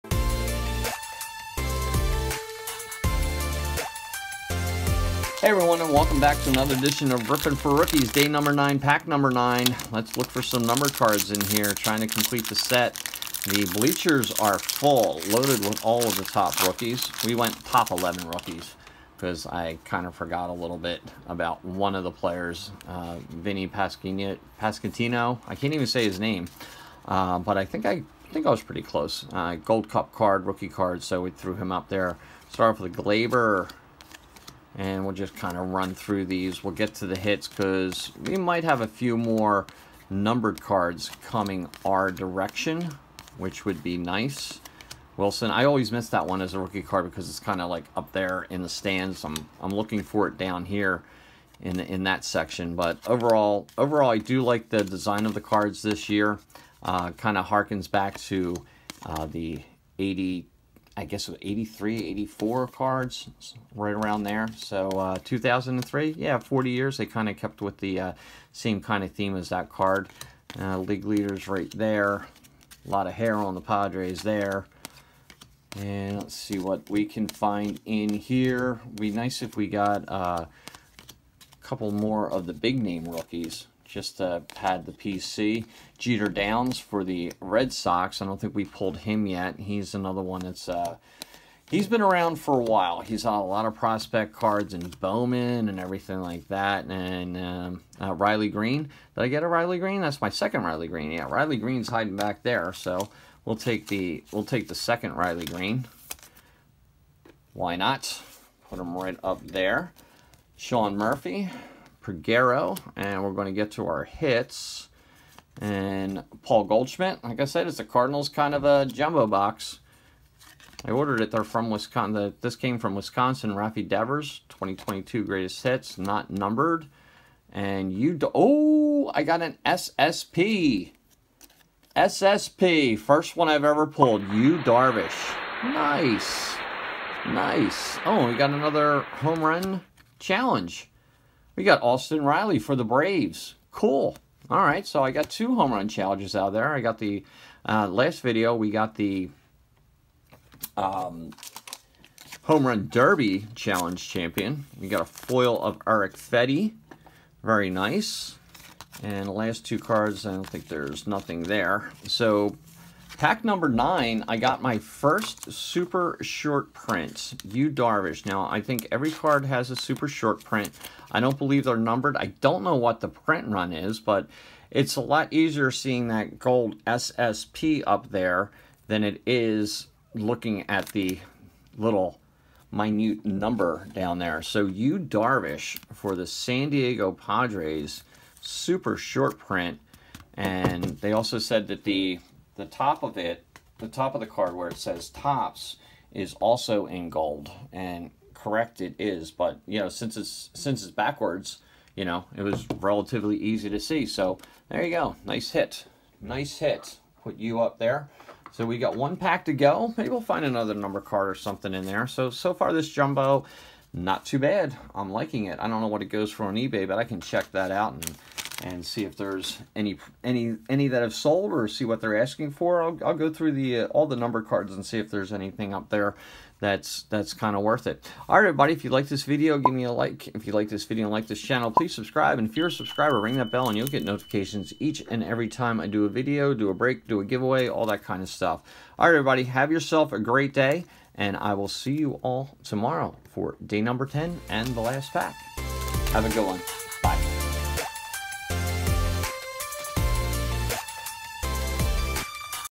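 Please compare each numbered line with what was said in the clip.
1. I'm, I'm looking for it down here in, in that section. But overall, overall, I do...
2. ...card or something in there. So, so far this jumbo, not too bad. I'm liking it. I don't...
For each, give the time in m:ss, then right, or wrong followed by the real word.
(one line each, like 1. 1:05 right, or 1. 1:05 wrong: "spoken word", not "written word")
1. 0:49 right
2. 3:30 right.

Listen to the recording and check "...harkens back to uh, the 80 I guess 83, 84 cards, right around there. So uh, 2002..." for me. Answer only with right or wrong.
wrong.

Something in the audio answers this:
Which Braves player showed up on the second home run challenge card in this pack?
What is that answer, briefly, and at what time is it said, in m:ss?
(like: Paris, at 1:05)
Austin Riley, at 2:21.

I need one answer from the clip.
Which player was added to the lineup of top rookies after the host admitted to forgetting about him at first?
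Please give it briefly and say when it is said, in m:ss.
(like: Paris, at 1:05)
Vinny Pascatino, at 0:23.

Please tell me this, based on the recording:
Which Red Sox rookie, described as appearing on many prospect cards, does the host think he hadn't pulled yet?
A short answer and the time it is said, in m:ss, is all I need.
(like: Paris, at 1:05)
Jeter Downs, at 1:25.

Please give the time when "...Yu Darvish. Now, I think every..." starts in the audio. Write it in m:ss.
2:47.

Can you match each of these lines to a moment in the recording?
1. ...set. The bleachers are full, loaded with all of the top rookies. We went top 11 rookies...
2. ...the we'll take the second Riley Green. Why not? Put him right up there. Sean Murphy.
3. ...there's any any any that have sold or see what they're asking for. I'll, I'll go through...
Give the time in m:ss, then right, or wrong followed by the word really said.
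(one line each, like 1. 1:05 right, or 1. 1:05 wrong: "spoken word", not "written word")
1. 0:12 right
2. 1:43 right
3. 3:39 right.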